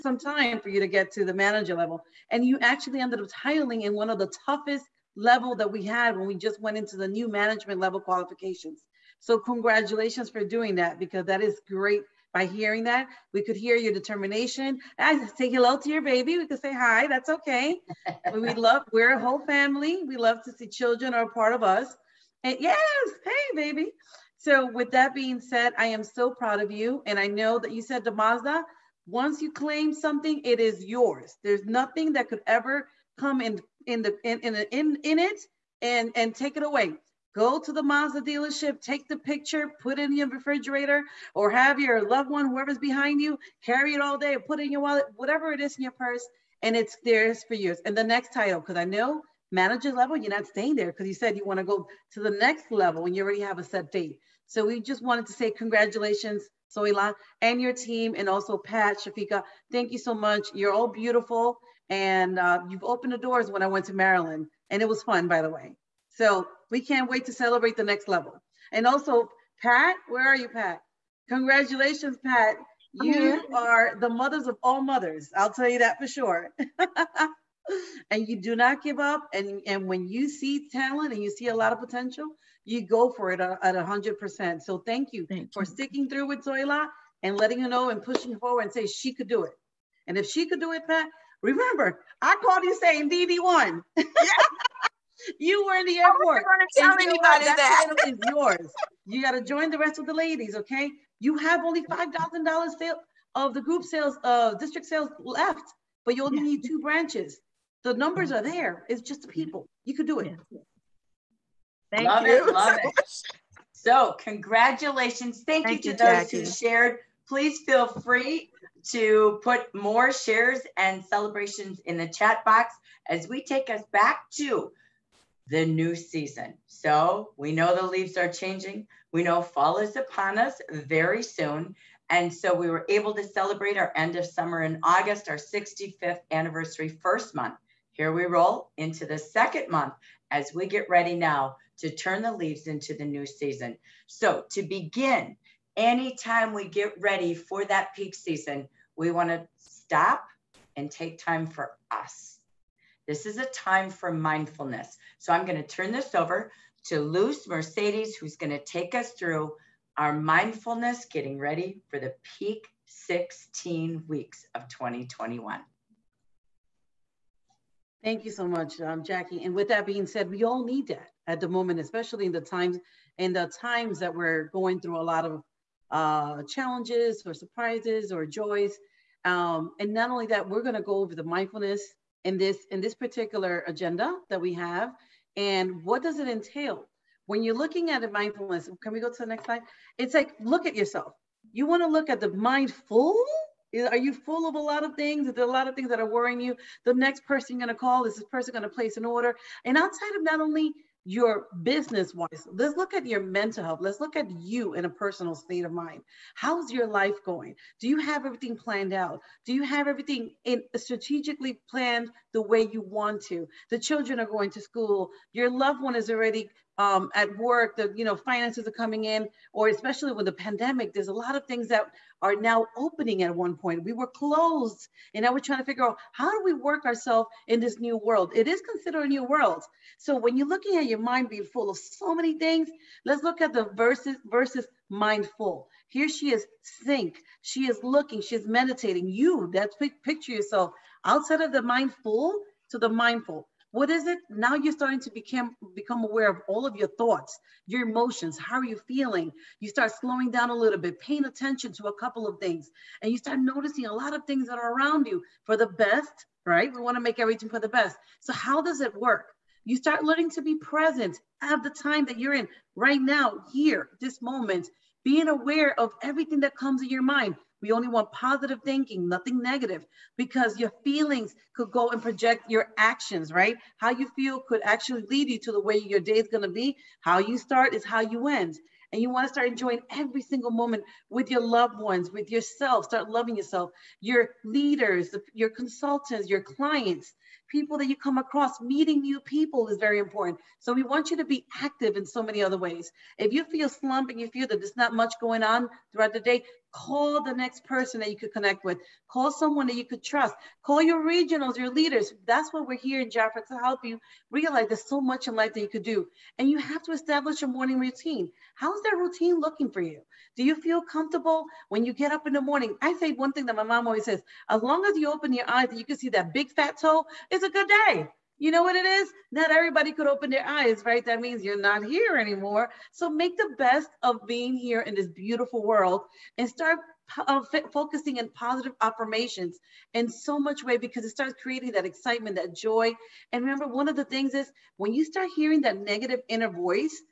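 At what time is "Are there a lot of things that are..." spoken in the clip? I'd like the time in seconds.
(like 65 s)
195 s.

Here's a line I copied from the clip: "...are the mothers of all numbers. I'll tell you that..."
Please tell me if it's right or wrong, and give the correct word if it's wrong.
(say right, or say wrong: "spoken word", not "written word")
wrong: "mothers", not "numbers".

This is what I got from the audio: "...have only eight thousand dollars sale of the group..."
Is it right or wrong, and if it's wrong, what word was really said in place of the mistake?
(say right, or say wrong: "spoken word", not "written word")
wrong: "five", not "eight".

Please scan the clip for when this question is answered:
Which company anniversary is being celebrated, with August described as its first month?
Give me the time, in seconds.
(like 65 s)
135 s.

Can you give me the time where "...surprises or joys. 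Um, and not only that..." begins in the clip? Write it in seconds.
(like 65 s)
177 s.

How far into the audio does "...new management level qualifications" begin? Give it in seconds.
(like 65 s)
7 s.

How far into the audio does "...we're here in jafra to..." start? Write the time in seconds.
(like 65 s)
302 s.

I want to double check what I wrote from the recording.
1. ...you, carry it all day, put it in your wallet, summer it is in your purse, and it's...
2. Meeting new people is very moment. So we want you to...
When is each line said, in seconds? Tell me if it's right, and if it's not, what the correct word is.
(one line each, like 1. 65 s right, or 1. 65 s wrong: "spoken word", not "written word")
1. 43 s wrong: "whatever", not "summer"
2. 288 s wrong: "important", not "moment".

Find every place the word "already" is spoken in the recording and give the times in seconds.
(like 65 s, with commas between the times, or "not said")
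53 s, 216 s.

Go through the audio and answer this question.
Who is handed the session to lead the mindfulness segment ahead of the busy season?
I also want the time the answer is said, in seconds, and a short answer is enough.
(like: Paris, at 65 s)
Luz Mercedes, at 157 s.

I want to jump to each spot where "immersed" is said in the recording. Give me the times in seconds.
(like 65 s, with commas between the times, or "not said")
not said.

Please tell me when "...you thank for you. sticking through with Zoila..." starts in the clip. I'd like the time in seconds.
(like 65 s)
85 s.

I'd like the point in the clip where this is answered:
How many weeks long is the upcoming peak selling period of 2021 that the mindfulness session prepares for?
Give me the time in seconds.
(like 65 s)
162 s.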